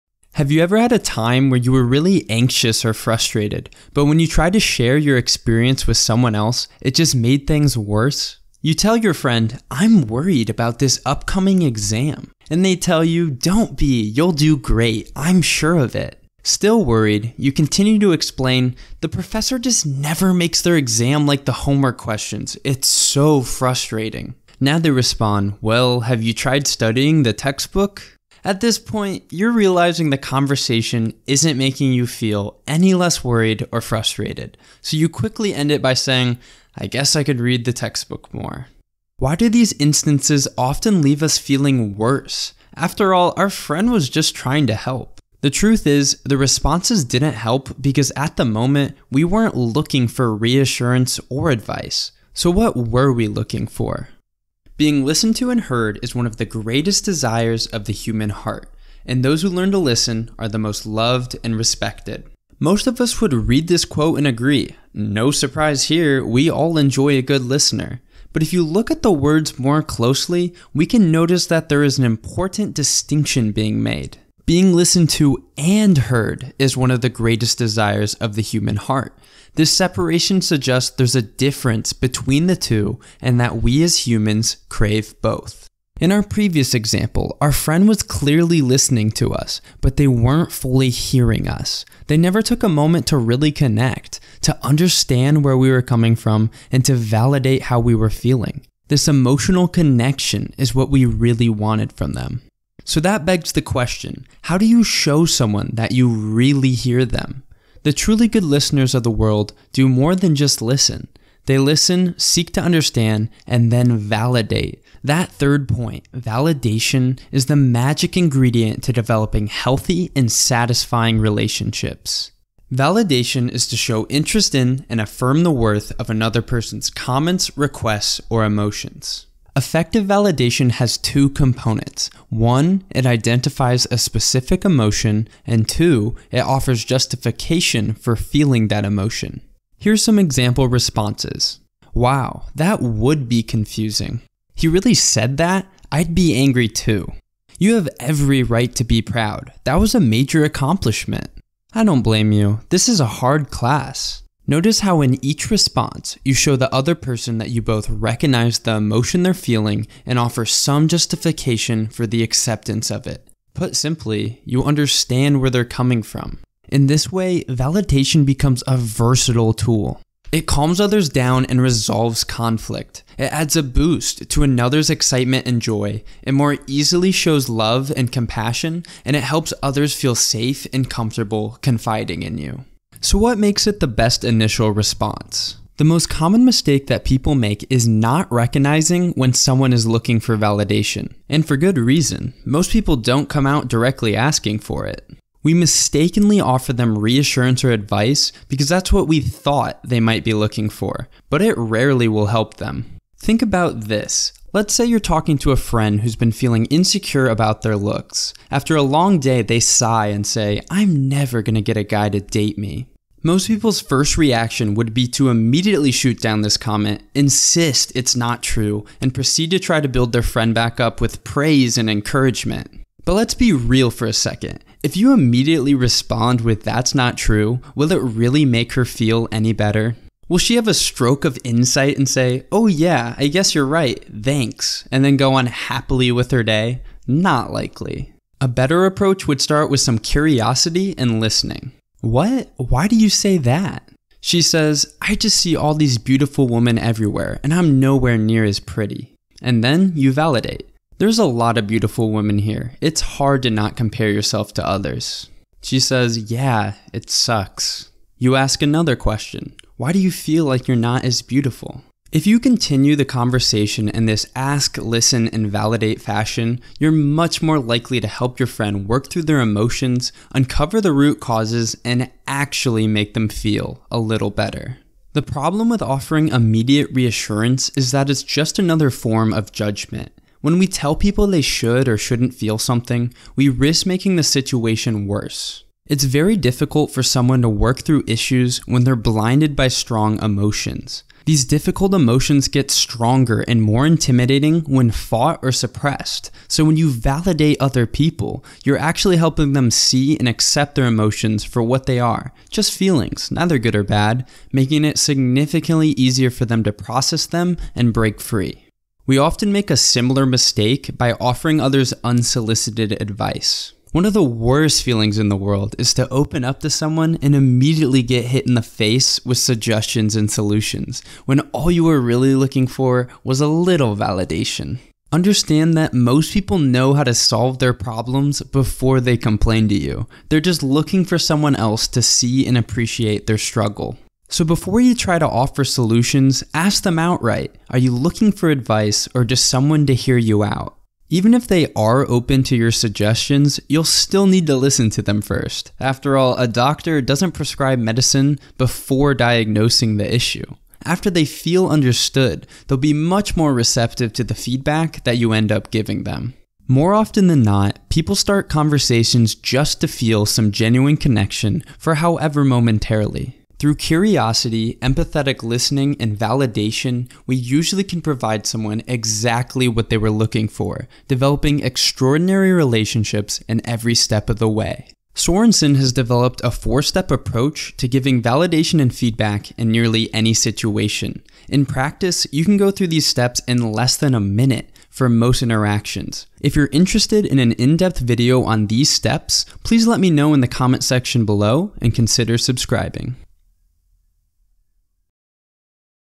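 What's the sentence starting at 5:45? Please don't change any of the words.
After all, a doctor doesn't prescribe medicine before diagnosing the issue.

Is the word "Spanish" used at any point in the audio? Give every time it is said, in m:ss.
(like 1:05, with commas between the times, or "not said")
not said.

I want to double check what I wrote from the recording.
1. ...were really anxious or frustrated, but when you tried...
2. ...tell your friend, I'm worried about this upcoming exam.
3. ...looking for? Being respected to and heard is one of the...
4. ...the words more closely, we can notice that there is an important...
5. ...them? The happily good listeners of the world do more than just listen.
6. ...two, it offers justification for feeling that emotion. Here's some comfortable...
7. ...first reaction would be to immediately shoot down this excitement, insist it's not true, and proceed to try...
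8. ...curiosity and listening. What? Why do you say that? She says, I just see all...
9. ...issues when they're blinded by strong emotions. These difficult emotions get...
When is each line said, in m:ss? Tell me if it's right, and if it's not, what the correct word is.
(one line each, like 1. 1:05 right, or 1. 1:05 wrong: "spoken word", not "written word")
1. 0:01 right
2. 0:08 right
3. 0:53 wrong: "listened", not "respected"
4. 1:09 right
5. 1:47 wrong: "truly", not "happily"
6. 2:15 wrong: "example", not "comfortable"
7. 3:33 wrong: "comment", not "excitement"
8. 3:59 right
9. 4:48 right.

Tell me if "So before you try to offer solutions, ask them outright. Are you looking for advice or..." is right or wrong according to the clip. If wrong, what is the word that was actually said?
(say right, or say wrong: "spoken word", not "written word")
right.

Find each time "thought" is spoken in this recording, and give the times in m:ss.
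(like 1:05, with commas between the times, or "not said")
3:19.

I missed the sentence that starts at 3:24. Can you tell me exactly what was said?
Let's say you're talking to a friend who's been feeling insecure about their looks.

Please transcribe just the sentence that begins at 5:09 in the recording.
We often make a similar mistake by offering others unsolicited advice.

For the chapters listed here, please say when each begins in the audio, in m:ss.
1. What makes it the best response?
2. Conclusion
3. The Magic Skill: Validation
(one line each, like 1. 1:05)
1. 3:02
2. 5:56
3. 1:43.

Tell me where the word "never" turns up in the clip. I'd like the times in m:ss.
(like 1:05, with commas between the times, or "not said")
0:19, 1:32, 3:31.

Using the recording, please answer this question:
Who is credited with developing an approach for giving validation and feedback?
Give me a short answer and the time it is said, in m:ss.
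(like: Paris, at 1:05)
Sorensen, at 6:15.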